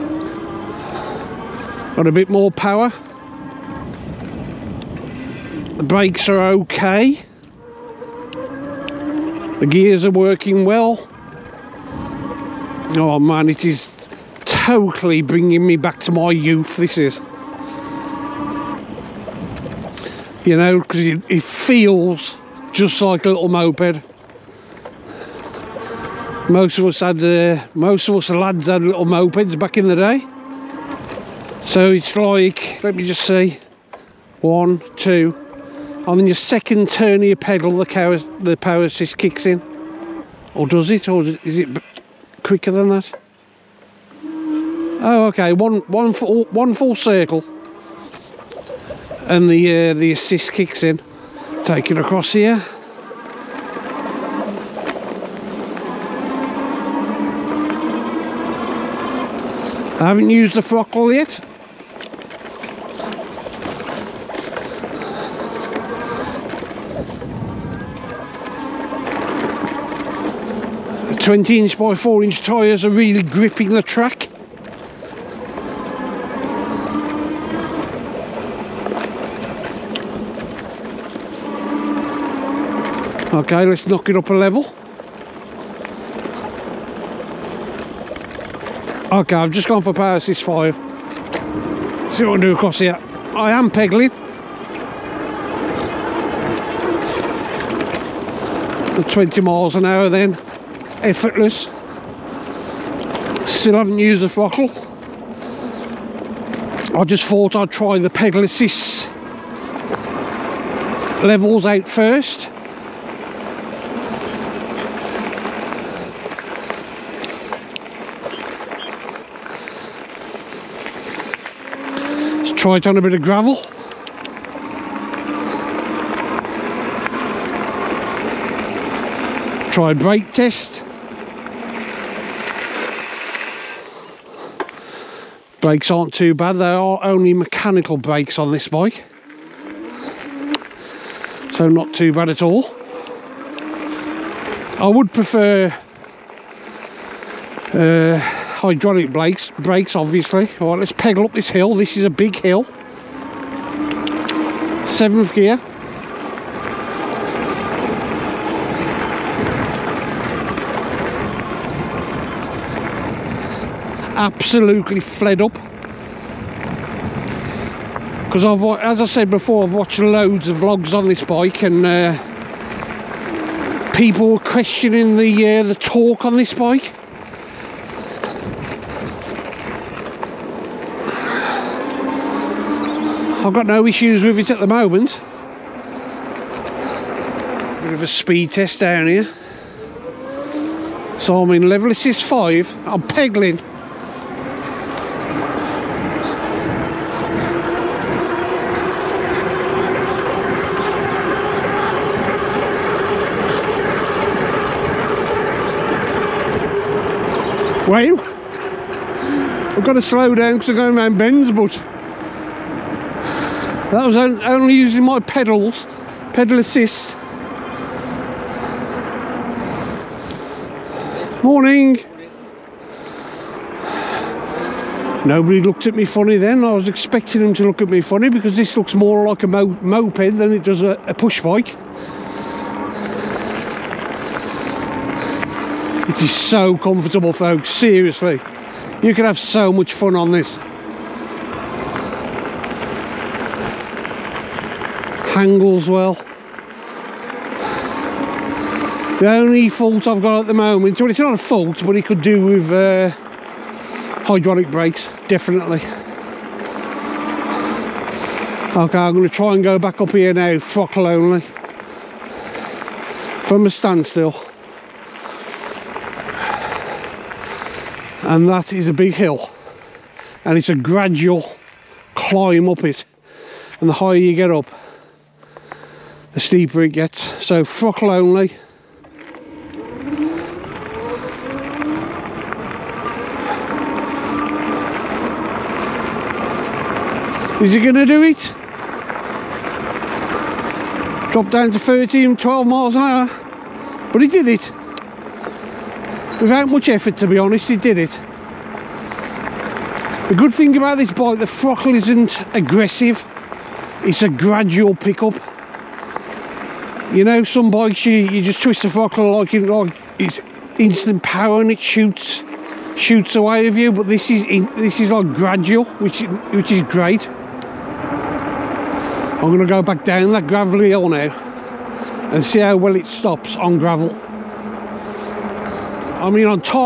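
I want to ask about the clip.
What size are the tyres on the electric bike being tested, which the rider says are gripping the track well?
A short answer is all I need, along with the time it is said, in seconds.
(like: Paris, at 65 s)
20 inch by 4 inch, at 71 s.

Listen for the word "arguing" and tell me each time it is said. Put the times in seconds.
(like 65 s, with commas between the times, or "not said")
not said.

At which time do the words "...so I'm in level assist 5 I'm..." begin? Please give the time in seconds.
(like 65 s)
191 s.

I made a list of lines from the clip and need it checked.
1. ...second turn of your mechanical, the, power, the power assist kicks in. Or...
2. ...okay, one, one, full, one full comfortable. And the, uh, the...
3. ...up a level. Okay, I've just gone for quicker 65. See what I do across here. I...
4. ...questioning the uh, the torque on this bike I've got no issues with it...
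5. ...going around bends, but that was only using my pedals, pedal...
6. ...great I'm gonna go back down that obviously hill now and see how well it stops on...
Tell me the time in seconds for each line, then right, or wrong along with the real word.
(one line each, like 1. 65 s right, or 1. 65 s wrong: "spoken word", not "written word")
1. 36 s wrong: "pedal", not "mechanical"
2. 45 s wrong: "circle", not "comfortable"
3. 84 s wrong: "power", not "quicker"
4. 174 s right
5. 210 s right
6. 316 s wrong: "gravelly", not "obviously".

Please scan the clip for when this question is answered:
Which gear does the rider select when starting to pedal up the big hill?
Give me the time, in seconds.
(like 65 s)
154 s.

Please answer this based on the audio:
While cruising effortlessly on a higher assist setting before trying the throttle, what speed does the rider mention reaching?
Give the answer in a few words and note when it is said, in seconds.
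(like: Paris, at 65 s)
20 miles an hour, at 99 s.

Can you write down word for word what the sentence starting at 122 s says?
Let's try it on a bit of gravel.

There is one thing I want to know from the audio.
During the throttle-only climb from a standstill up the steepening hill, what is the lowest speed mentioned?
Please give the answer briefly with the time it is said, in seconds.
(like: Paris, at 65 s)
12 miles an hour, at 292 s.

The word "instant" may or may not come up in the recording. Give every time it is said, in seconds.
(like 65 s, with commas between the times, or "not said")
310 s.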